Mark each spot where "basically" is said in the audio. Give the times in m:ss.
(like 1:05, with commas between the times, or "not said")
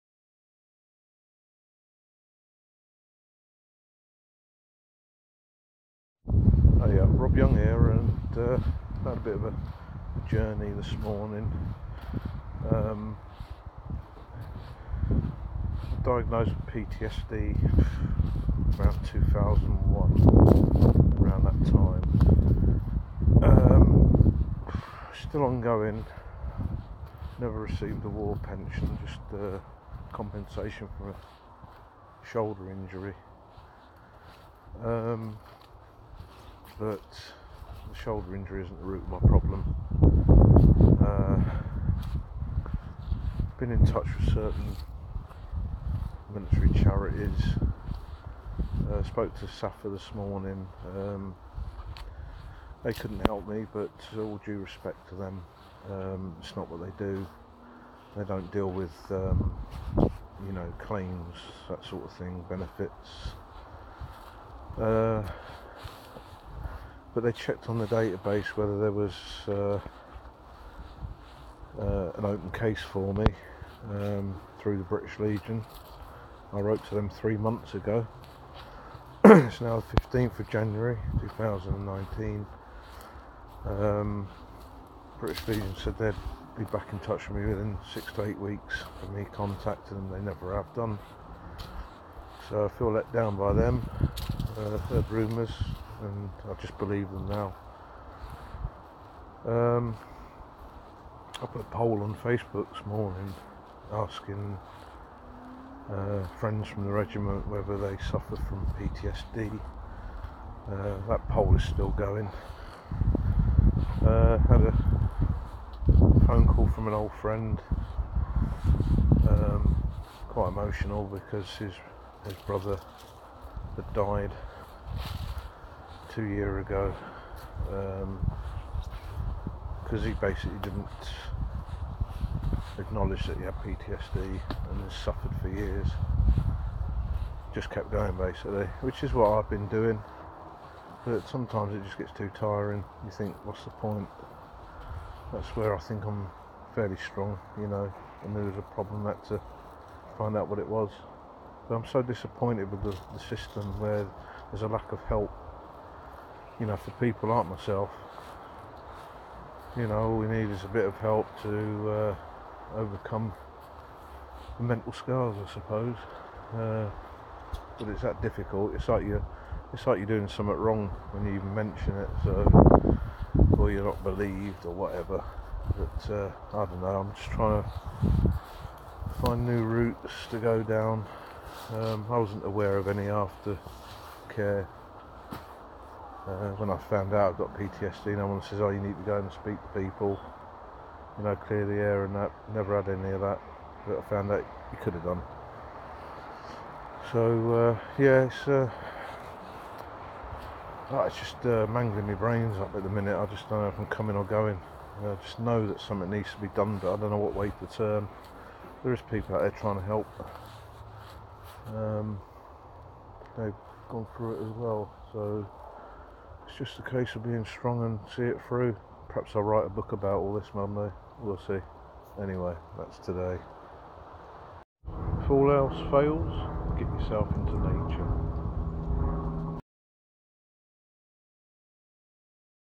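2:10, 2:18.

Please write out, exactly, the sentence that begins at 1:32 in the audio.
So I feel let down by them uh, heard rumours, and I just believe them now.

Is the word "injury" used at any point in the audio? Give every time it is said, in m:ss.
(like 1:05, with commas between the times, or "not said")
0:32, 0:38.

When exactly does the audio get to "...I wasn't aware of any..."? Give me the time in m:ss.
3:02.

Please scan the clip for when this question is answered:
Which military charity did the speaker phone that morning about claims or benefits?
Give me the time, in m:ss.
0:49.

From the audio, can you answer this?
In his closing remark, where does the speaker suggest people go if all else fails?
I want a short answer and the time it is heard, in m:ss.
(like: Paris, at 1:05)
nature, at 3:47.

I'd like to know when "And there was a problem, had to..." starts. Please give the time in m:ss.
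2:28.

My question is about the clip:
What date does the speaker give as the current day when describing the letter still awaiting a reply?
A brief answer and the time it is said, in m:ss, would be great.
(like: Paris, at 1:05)
15 January 2019, at 1:20.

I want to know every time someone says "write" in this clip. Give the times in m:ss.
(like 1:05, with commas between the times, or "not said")
3:39.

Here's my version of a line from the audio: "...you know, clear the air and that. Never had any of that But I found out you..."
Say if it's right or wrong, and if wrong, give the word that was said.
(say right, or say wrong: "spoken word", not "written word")
right.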